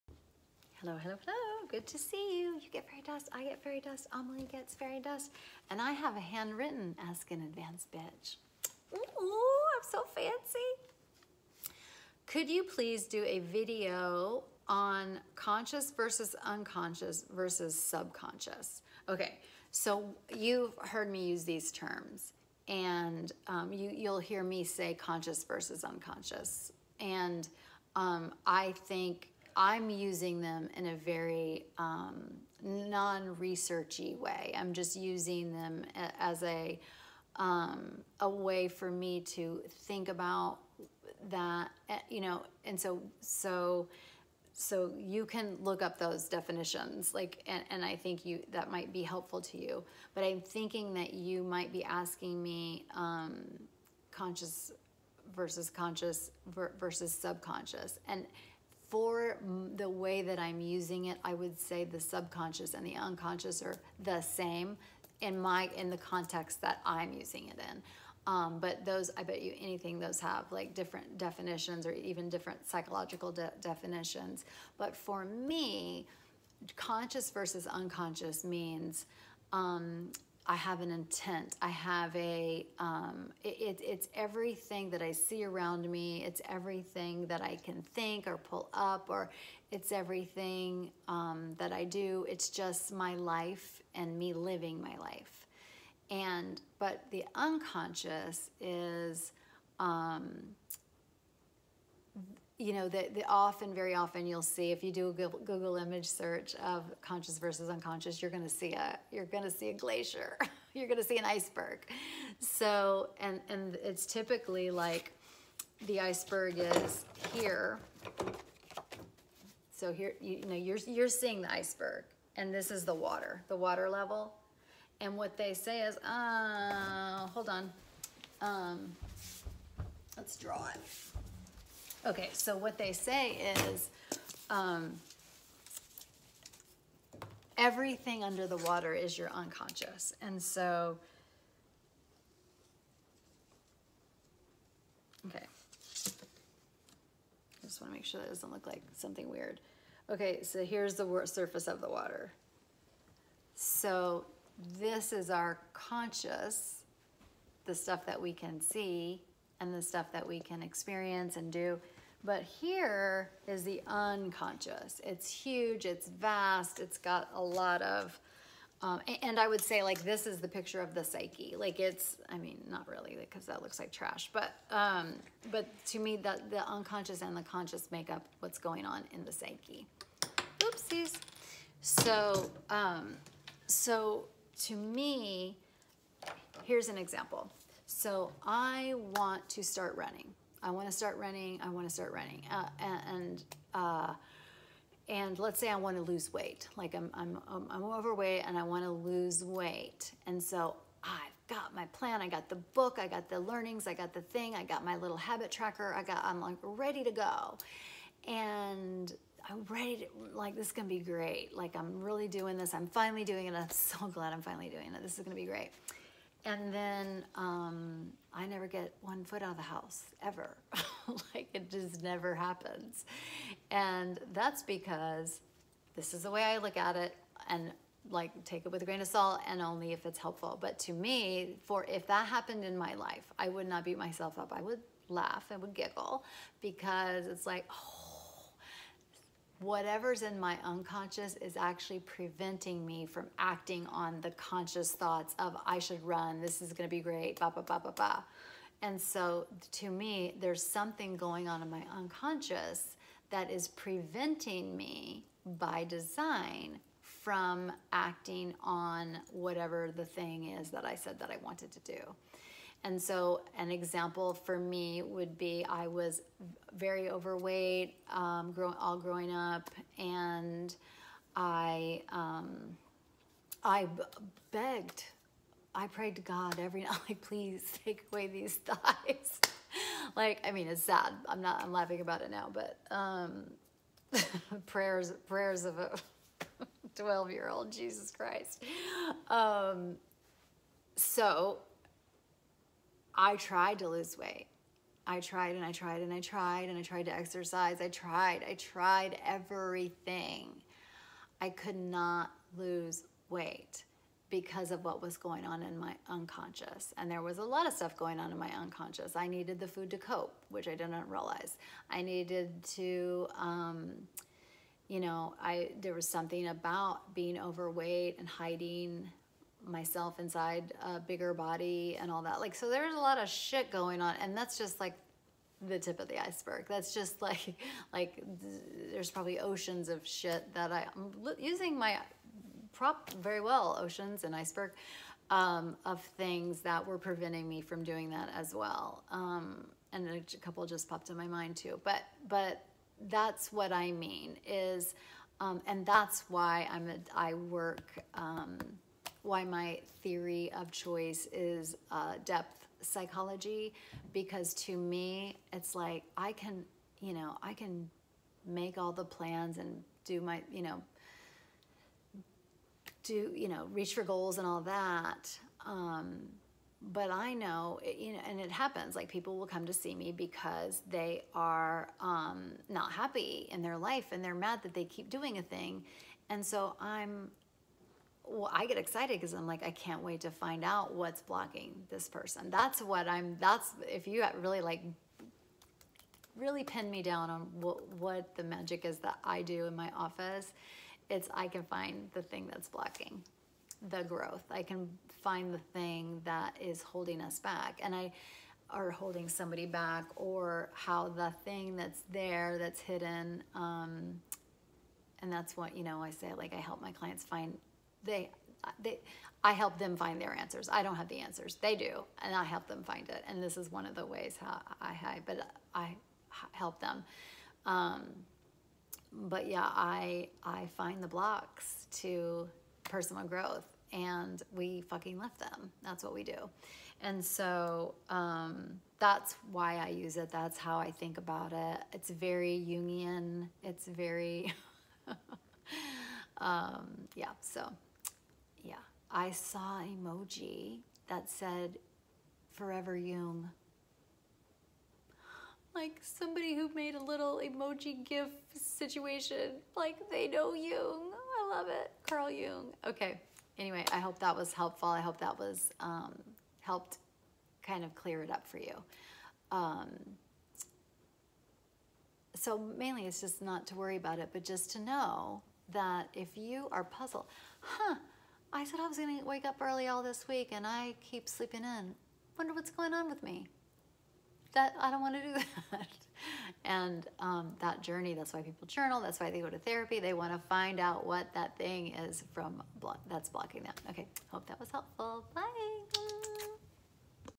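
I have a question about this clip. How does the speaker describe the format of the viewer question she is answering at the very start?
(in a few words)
handwritten.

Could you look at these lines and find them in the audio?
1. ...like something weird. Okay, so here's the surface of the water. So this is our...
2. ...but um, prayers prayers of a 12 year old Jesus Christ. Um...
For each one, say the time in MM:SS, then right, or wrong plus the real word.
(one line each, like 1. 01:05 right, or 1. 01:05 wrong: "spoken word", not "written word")
1. 02:28 right
2. 04:42 right.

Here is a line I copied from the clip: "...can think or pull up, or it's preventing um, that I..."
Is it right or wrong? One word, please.
wrong.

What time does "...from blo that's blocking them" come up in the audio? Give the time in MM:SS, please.
08:02.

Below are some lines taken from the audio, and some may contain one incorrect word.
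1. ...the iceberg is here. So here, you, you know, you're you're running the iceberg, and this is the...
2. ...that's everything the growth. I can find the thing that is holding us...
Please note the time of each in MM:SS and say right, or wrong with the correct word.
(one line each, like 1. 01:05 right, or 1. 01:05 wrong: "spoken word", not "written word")
1. 01:55 wrong: "seeing", not "running"
2. 06:32 wrong: "blocking", not "everything".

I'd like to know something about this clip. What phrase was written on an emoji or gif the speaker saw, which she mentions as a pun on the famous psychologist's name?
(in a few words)
Forever Jung.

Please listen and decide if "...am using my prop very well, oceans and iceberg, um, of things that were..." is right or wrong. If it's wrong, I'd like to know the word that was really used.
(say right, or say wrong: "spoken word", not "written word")
right.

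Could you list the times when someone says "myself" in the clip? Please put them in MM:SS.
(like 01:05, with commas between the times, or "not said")
03:53, 05:19.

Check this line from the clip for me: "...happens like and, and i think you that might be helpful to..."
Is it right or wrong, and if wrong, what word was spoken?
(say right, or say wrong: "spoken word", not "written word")
wrong: "definitions", not "happens".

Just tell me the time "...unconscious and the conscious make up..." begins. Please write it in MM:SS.
02:56.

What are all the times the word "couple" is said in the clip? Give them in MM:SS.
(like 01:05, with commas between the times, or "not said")
05:40.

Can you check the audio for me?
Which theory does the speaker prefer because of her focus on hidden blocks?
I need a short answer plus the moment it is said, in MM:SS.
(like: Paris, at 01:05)
depth psychology, at 05:52.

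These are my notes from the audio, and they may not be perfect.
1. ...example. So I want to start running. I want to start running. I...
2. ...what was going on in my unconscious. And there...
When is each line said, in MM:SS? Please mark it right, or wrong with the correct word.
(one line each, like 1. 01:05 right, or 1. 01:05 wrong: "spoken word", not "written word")
1. 03:06 right
2. 05:04 right.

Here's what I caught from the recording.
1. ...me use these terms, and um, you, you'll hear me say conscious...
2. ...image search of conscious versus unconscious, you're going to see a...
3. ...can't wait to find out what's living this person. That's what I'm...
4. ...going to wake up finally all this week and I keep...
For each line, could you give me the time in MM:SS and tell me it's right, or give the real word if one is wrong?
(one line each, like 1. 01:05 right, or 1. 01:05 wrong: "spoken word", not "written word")
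1. 00:21 right
2. 01:45 right
3. 06:19 wrong: "blocking", not "living"
4. 07:48 wrong: "early", not "finally".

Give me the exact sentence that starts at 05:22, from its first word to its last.
Like, so there's a lot of shit going on.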